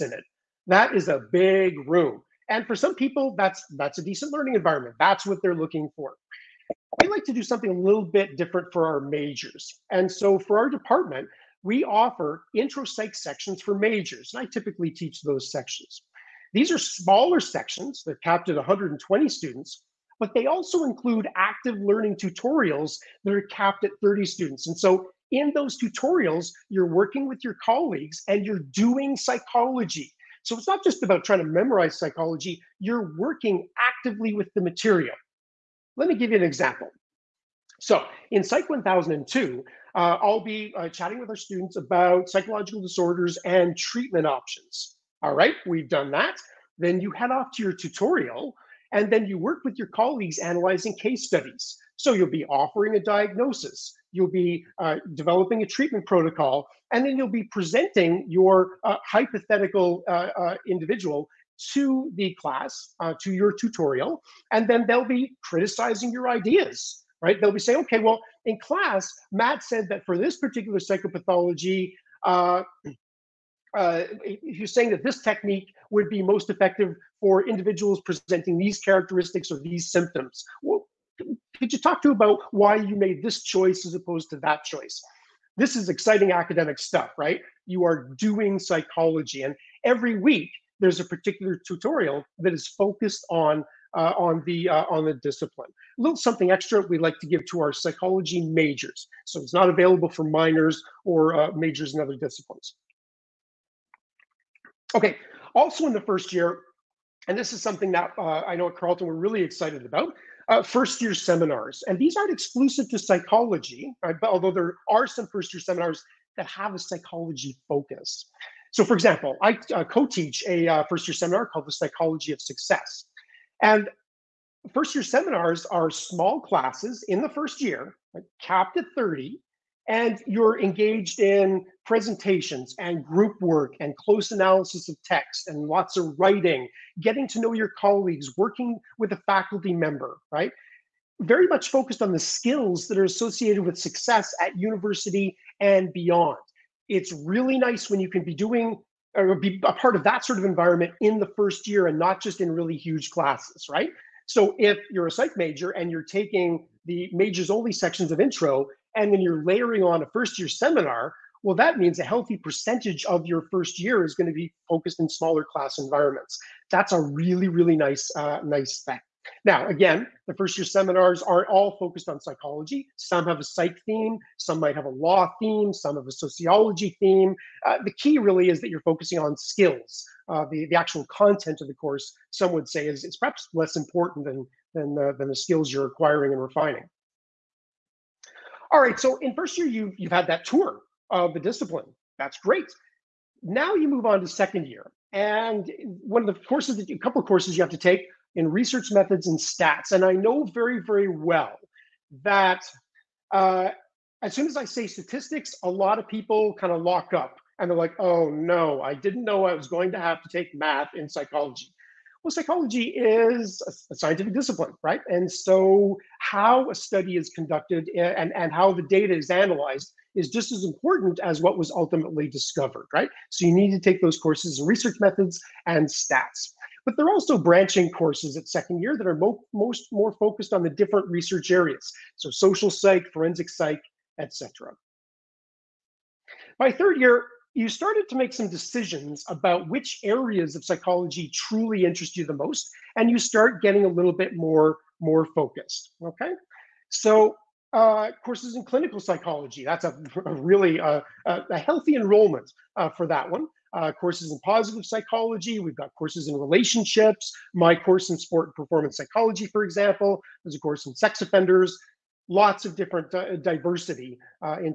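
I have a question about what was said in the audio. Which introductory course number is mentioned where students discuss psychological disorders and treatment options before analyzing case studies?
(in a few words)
Psych 1002.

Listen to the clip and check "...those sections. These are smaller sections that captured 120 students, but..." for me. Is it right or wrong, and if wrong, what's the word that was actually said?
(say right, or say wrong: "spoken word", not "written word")
right.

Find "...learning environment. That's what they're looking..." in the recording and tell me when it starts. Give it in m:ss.
0:04.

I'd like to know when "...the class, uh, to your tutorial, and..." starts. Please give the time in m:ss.
1:02.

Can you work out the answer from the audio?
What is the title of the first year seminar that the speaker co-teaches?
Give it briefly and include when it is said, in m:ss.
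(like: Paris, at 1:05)
The Psychology of Success, at 2:01.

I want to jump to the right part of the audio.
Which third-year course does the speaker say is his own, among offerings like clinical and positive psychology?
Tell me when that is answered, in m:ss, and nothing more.
4:18.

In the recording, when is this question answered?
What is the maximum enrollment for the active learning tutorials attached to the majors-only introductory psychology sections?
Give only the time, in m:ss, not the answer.
0:23.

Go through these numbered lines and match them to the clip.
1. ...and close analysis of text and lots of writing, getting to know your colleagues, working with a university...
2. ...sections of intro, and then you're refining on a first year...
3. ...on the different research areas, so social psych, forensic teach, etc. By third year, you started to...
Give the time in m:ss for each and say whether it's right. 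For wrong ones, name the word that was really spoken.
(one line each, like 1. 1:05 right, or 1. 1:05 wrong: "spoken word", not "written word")
1. 2:13 wrong: "faculty", not "university"
2. 2:37 wrong: "layering", not "refining"
3. 3:50 wrong: "psych", not "teach".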